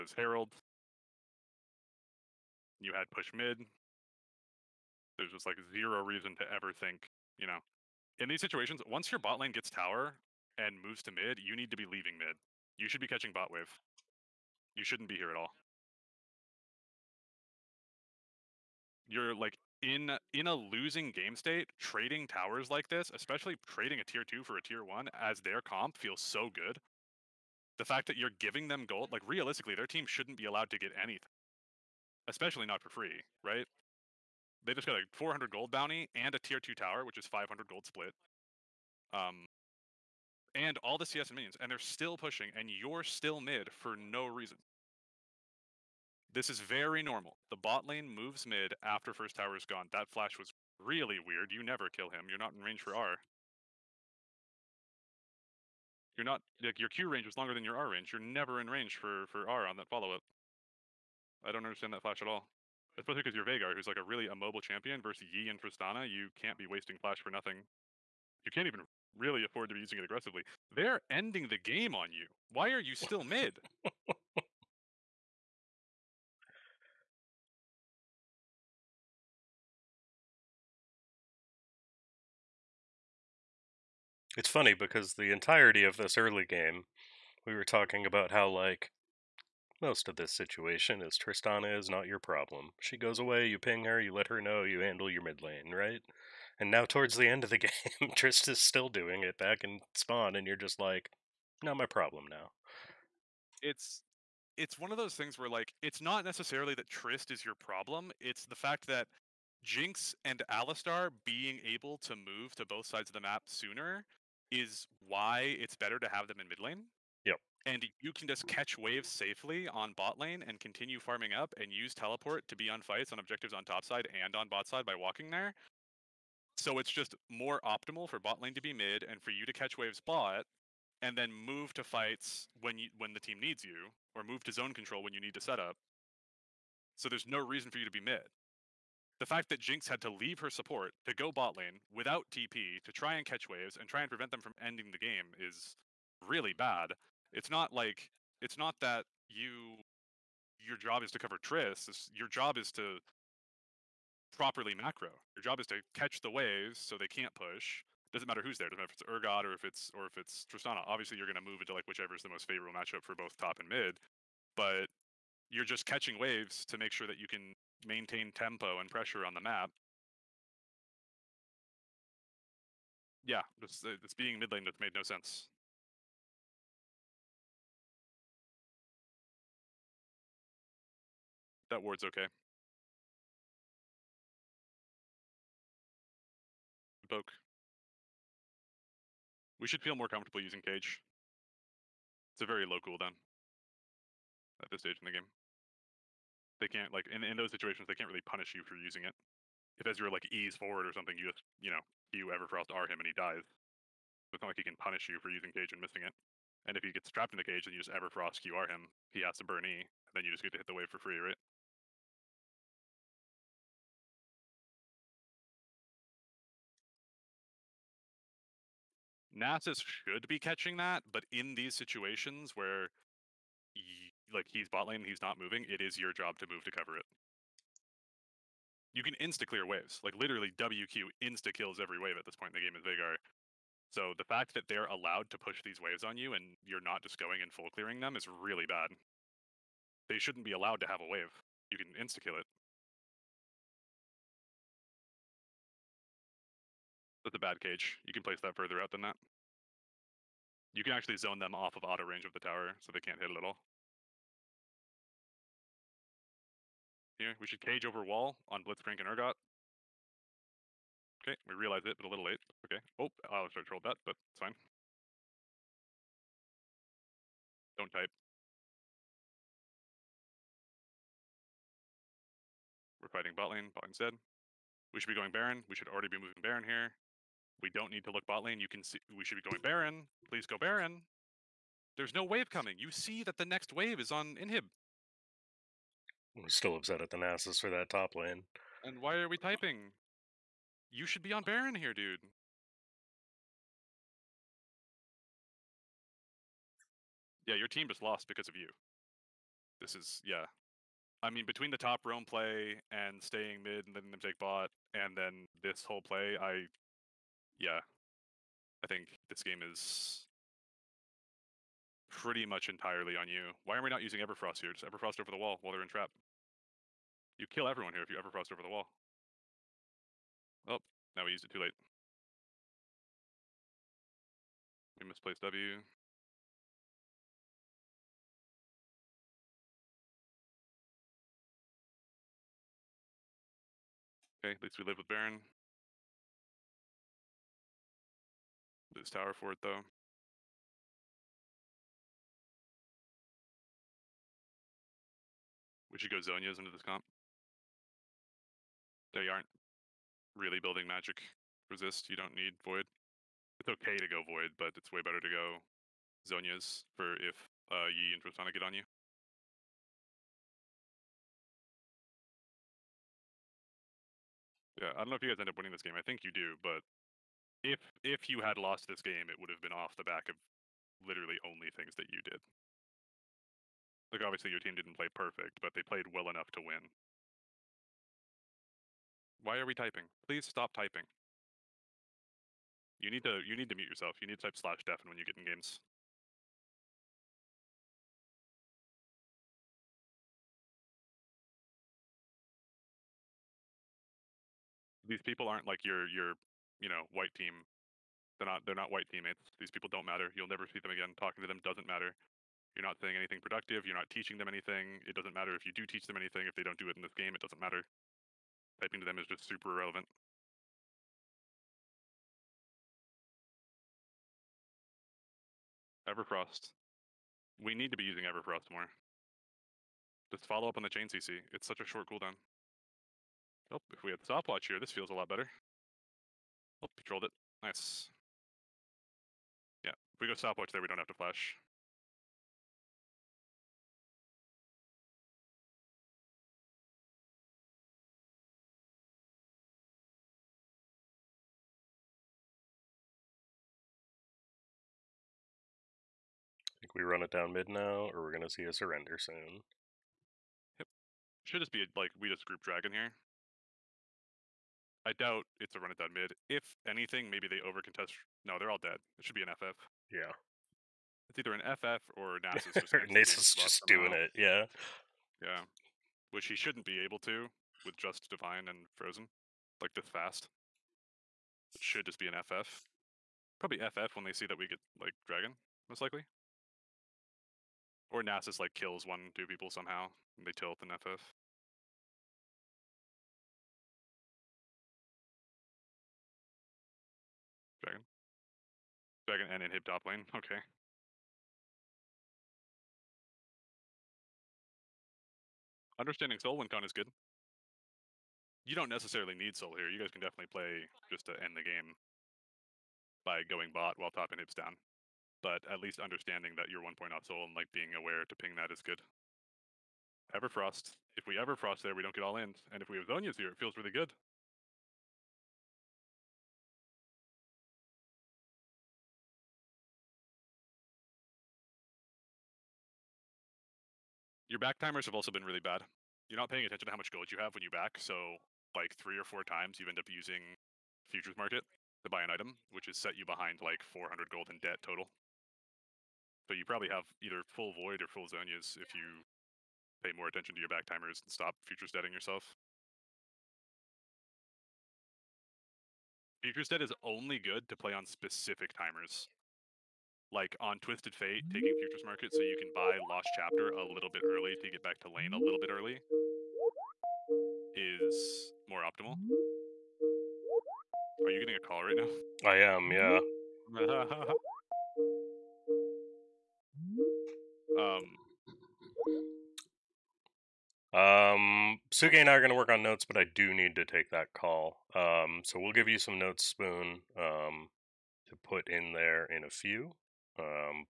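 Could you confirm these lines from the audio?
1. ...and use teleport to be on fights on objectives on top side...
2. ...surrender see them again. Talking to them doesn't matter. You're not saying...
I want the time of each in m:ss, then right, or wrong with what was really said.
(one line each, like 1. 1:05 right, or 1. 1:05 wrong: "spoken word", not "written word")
1. 2:01 right
2. 6:40 wrong: "never", not "surrender".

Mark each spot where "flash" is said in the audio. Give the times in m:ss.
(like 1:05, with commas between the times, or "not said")
0:50, 1:02, 1:07, 7:11.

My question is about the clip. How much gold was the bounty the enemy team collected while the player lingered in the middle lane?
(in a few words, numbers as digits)
400.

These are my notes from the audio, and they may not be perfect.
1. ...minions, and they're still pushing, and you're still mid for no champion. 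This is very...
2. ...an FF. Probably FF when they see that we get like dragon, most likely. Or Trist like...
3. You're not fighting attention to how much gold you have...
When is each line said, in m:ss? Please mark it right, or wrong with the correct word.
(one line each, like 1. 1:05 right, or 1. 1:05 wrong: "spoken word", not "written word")
1. 0:41 wrong: "reason", not "champion"
2. 7:52 wrong: "Nasus", not "Trist"
3. 8:46 wrong: "paying", not "fighting".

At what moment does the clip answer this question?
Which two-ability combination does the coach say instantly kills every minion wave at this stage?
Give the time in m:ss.
3:50.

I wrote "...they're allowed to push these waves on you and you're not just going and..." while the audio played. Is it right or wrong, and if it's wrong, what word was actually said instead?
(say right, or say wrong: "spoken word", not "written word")
right.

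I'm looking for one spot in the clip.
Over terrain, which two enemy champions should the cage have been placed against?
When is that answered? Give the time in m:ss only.
4:18.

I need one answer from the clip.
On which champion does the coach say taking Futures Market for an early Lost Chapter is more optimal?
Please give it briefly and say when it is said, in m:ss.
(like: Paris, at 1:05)
Twisted Fate, at 9:10.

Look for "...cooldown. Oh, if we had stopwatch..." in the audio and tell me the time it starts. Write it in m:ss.
7:02.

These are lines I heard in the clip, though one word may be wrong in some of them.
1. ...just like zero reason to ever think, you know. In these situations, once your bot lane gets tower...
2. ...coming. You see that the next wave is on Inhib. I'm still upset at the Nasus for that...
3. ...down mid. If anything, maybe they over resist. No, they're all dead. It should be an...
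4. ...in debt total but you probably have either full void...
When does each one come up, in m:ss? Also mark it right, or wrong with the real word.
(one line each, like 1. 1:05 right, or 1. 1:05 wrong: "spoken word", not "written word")
1. 0:05 right
2. 4:42 right
3. 7:35 wrong: "contest", not "resist"
4. 8:54 right.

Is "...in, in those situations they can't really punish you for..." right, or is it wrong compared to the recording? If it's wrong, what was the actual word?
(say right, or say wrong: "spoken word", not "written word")
right.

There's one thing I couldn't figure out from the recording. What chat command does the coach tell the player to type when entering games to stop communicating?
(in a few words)
/deafen.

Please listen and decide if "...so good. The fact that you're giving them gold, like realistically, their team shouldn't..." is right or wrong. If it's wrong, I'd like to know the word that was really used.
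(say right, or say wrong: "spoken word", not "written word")
right.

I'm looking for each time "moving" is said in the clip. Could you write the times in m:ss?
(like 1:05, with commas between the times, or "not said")
3:45, 4:36.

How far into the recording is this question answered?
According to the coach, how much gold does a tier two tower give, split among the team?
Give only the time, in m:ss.
0:37.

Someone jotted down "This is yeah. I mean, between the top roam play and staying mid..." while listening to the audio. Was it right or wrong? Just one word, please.
right.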